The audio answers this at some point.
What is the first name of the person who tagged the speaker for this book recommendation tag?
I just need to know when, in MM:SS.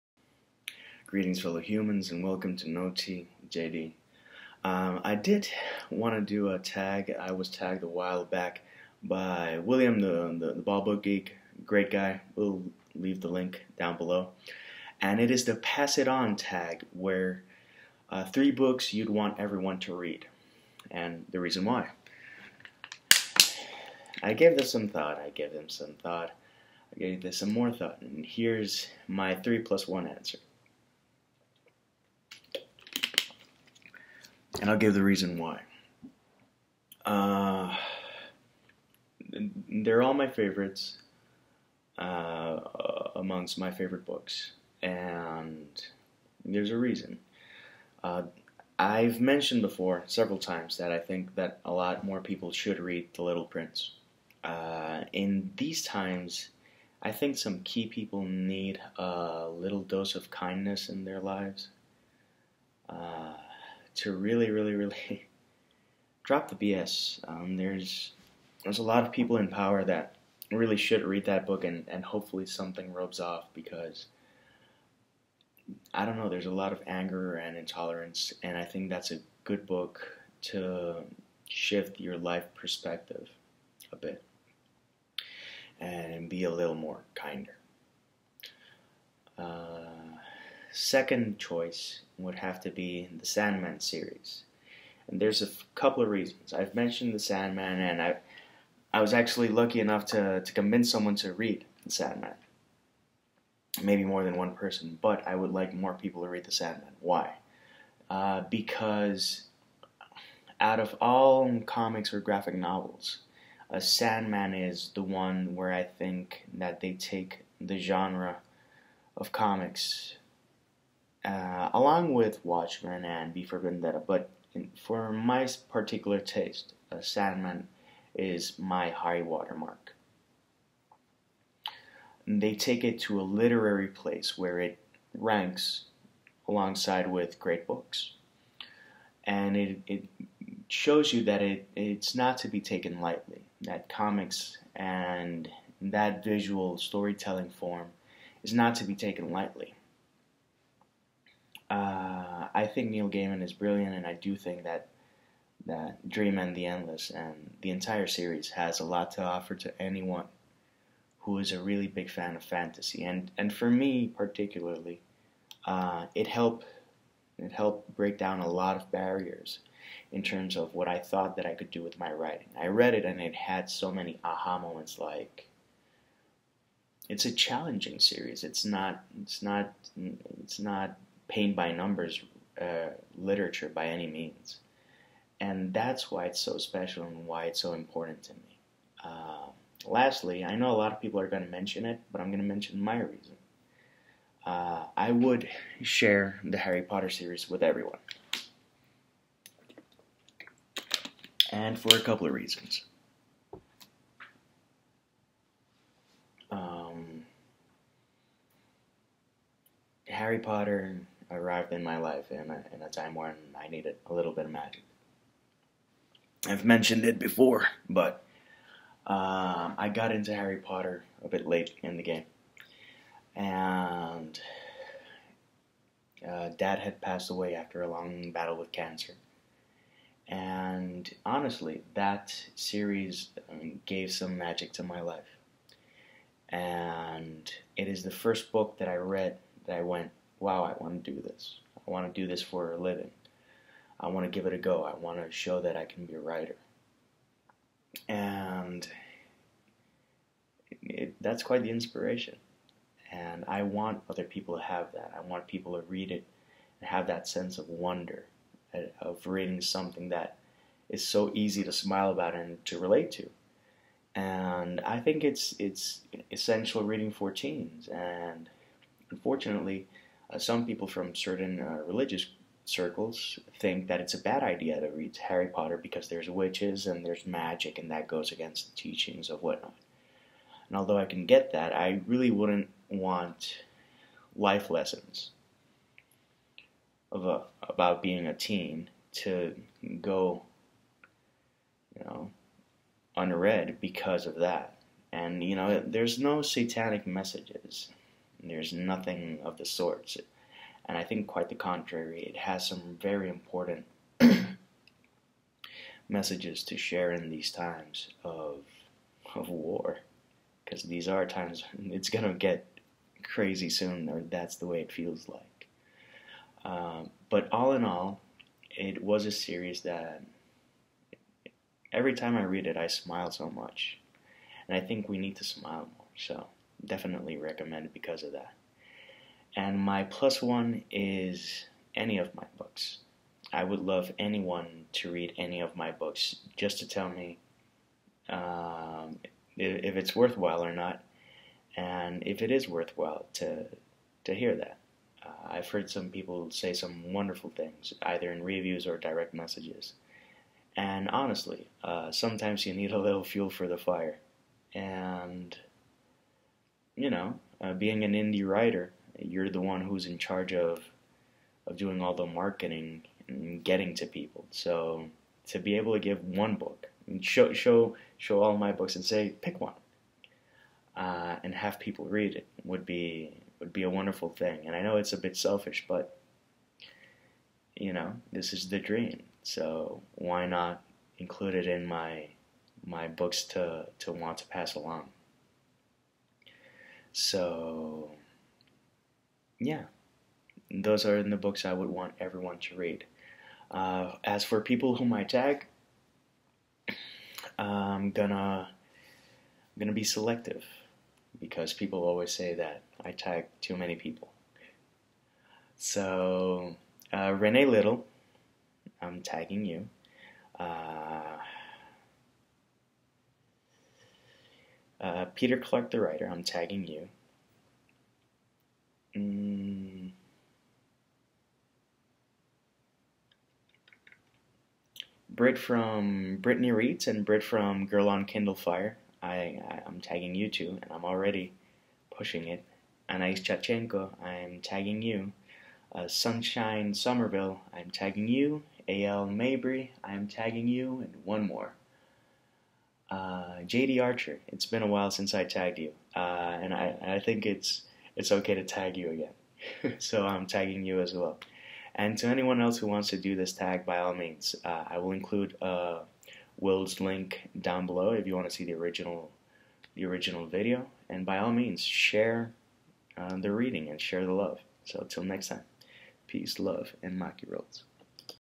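00:09.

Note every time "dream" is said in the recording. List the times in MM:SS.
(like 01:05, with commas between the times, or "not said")
02:36, 06:18.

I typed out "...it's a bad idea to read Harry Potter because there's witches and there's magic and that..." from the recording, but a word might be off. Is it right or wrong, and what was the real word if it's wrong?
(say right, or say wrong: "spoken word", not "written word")
right.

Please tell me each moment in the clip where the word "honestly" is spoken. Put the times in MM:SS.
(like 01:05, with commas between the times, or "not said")
03:51, 05:51.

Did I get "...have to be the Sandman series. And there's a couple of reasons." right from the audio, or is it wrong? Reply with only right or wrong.
right.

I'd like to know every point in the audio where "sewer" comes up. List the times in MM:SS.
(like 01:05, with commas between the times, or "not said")
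not said.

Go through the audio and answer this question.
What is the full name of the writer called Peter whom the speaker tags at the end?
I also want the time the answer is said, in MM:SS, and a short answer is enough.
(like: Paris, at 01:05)
Peter Clark, at 06:55.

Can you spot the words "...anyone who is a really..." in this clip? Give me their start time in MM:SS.
02:39.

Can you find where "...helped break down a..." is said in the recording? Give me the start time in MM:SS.
02:47.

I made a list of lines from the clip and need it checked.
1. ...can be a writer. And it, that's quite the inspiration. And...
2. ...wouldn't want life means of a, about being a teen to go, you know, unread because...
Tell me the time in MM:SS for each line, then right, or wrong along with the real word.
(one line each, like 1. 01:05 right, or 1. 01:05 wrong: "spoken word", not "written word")
1. 04:05 right
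2. 04:42 wrong: "lessons", not "means".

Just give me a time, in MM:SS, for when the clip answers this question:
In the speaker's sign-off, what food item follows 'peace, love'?
07:47.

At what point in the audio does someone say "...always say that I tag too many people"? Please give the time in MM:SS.
06:42.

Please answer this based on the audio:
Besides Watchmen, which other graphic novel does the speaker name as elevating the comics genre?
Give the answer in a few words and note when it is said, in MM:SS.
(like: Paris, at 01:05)
V for Vendetta, at 02:03.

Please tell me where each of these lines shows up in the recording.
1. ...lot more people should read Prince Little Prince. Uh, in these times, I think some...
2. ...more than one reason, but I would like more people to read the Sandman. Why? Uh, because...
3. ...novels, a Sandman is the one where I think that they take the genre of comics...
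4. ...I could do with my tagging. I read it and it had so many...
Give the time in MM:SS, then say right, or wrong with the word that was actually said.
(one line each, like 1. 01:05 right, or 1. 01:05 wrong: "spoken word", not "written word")
1. 00:51 wrong: "The", not "Prince"
2. 01:44 wrong: "person", not "reason"
3. 01:52 right
4. 02:51 wrong: "writing", not "tagging".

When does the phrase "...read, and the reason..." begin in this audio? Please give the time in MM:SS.
00:19.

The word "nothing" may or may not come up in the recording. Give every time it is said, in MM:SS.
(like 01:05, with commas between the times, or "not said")
04:58.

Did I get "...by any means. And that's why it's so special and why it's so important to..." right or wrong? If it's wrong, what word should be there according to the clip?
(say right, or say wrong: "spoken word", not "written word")
right.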